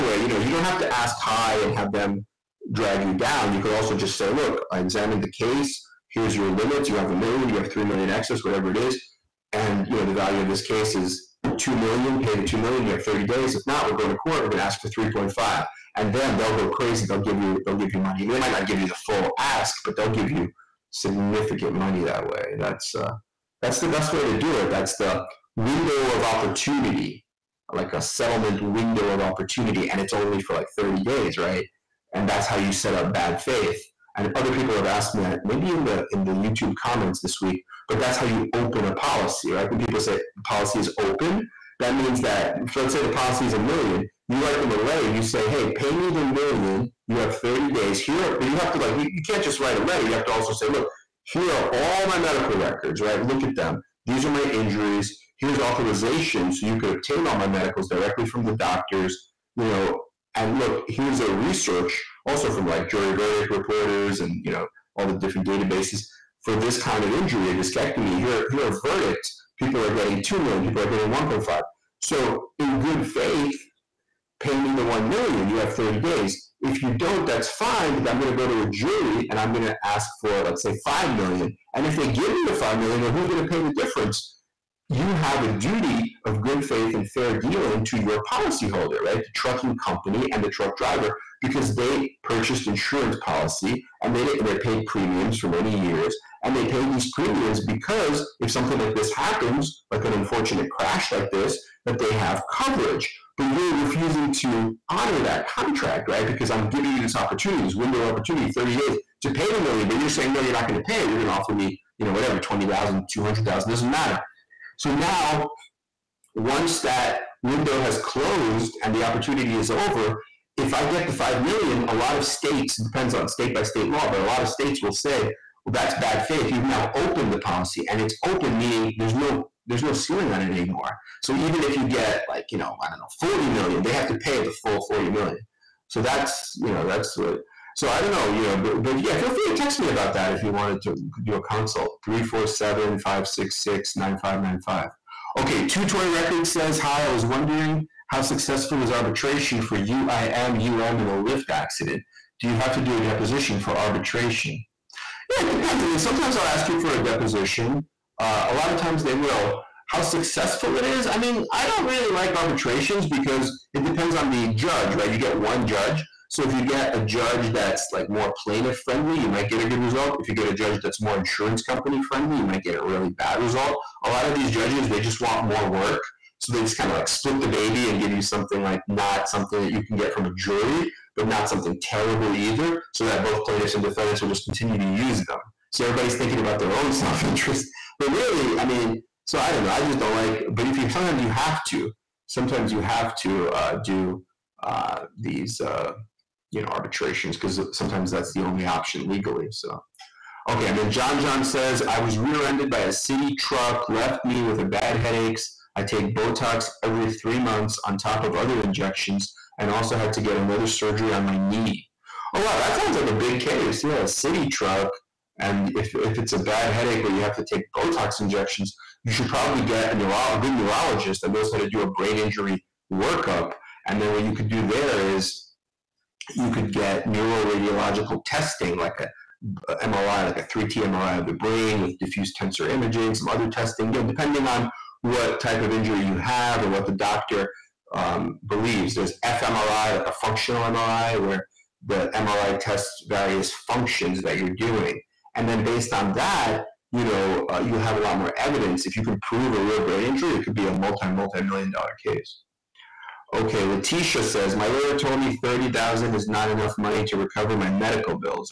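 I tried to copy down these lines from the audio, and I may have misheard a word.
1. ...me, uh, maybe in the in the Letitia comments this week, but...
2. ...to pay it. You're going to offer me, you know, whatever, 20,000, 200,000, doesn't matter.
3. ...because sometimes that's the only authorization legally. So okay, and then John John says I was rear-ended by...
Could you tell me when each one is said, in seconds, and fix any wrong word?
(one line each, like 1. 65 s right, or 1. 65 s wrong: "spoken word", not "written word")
1. 35 s wrong: "YouTube", not "Letitia"
2. 110 s right
3. 197 s wrong: "option", not "authorization".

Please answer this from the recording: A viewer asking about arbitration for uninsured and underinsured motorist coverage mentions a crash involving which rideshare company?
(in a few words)
Lyft.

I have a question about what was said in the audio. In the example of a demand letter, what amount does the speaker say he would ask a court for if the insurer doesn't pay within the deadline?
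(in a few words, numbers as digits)
3.5 million.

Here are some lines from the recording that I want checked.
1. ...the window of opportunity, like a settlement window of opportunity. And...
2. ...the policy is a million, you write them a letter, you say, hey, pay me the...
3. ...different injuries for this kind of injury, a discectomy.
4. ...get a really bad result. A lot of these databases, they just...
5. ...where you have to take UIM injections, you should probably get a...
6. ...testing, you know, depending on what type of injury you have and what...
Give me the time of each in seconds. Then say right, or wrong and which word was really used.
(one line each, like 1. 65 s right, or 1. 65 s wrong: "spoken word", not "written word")
1. 24 s right
2. 42 s right
3. 65 s wrong: "databases", not "injuries"
4. 172 s wrong: "judges", not "databases"
5. 217 s wrong: "Botox", not "UIM"
6. 233 s right.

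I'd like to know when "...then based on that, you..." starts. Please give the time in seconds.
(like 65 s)
245 s.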